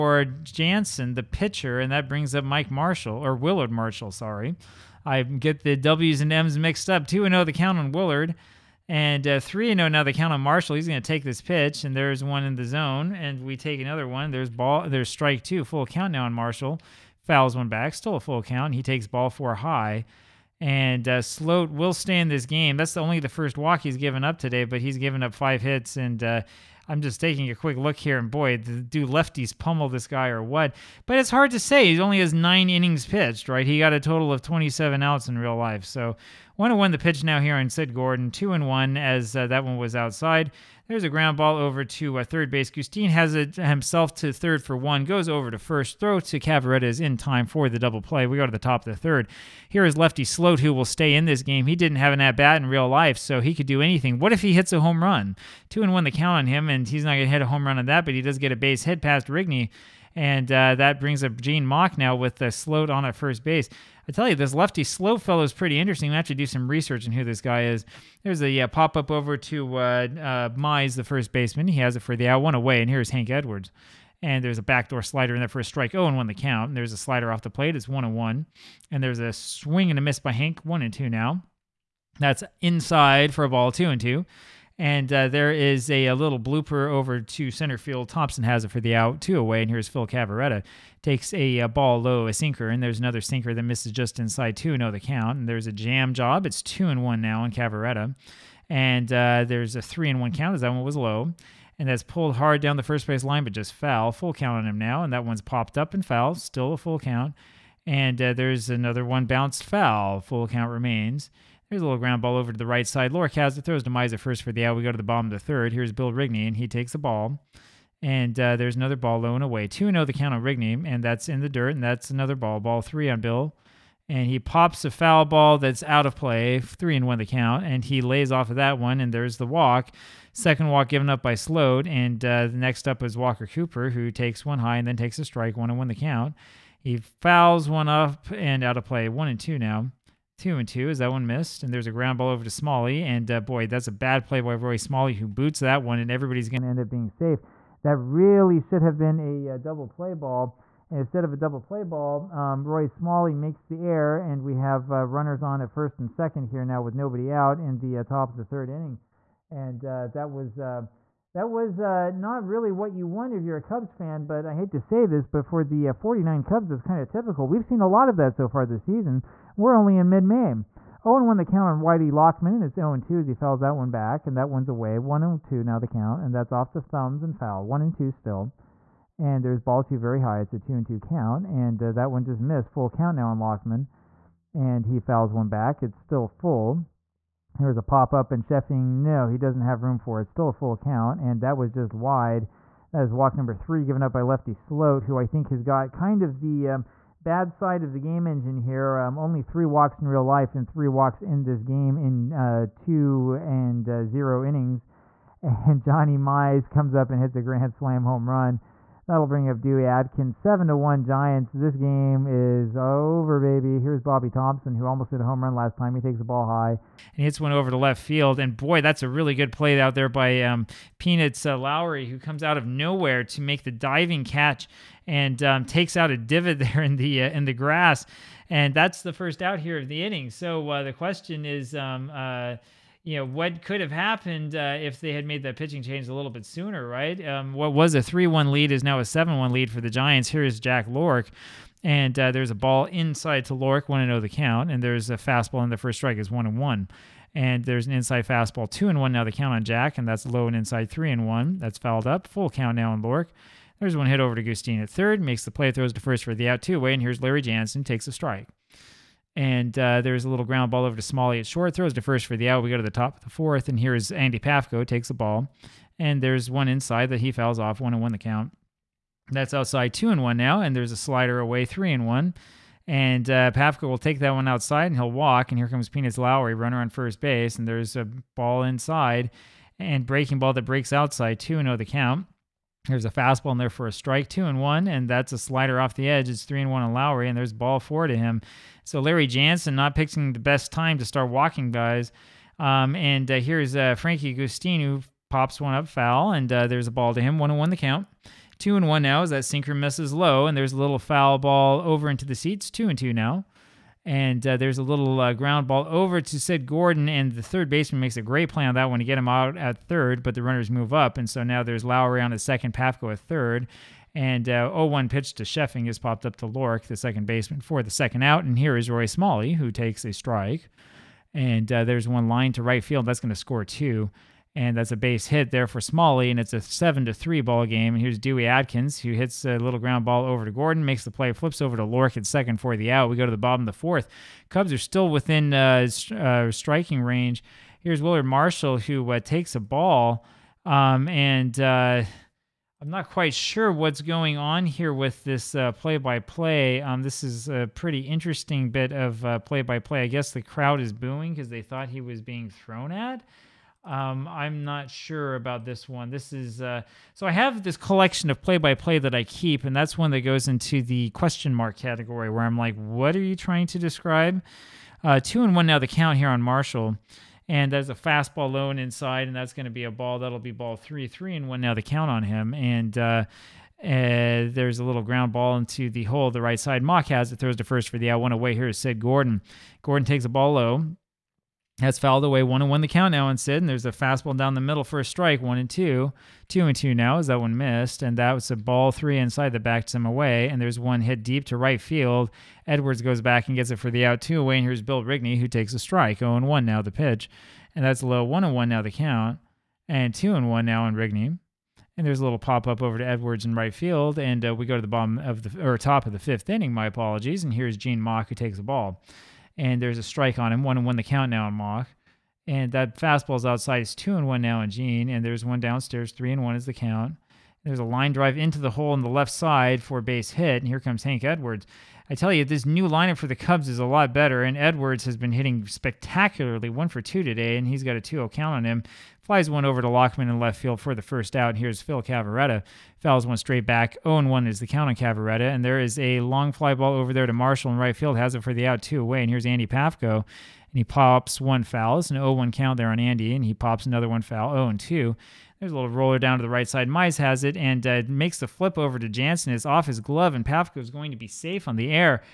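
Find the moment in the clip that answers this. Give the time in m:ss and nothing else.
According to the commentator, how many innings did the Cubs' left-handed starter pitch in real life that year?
0:32.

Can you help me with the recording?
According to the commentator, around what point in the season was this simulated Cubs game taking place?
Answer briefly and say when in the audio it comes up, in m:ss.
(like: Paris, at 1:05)
Mid May, at 2:50.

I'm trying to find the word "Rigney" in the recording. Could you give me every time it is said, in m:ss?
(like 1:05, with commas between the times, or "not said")
0:59, 1:56, 2:00, 6:35, 6:40.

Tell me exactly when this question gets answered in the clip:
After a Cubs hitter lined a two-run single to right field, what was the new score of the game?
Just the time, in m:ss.
5:26.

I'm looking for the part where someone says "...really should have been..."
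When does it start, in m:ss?
2:27.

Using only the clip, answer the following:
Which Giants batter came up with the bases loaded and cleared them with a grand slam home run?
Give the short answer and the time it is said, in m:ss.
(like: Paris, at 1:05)
Johnny Mize, at 3:25.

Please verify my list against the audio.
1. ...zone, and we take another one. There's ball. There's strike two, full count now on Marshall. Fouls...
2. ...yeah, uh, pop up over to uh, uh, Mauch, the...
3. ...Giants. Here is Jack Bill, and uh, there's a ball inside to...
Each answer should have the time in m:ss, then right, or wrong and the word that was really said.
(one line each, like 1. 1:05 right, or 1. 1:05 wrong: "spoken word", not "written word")
1. 0:12 right
2. 1:08 wrong: "Mize", not "Mauch"
3. 3:59 wrong: "Lohrke", not "Bill".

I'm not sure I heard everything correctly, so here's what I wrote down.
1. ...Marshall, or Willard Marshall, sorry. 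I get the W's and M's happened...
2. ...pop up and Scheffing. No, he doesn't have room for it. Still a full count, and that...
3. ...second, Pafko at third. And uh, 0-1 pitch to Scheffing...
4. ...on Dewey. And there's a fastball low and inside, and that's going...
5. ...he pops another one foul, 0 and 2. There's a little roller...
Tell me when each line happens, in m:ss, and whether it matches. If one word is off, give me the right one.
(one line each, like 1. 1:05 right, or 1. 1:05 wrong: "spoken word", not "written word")
1. 0:02 wrong: "mixed", not "happened"
2. 3:07 right
3. 5:12 right
4. 6:06 wrong: "Marshall", not "Dewey"
5. 7:23 right.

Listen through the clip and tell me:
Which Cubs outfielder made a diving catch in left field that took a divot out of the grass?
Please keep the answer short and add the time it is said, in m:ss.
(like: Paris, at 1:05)
Peanuts Lowrey, at 3:40.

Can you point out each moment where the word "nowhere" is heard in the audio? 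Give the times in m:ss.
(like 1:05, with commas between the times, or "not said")
3:42.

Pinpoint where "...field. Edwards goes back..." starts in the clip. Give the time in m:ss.
6:31.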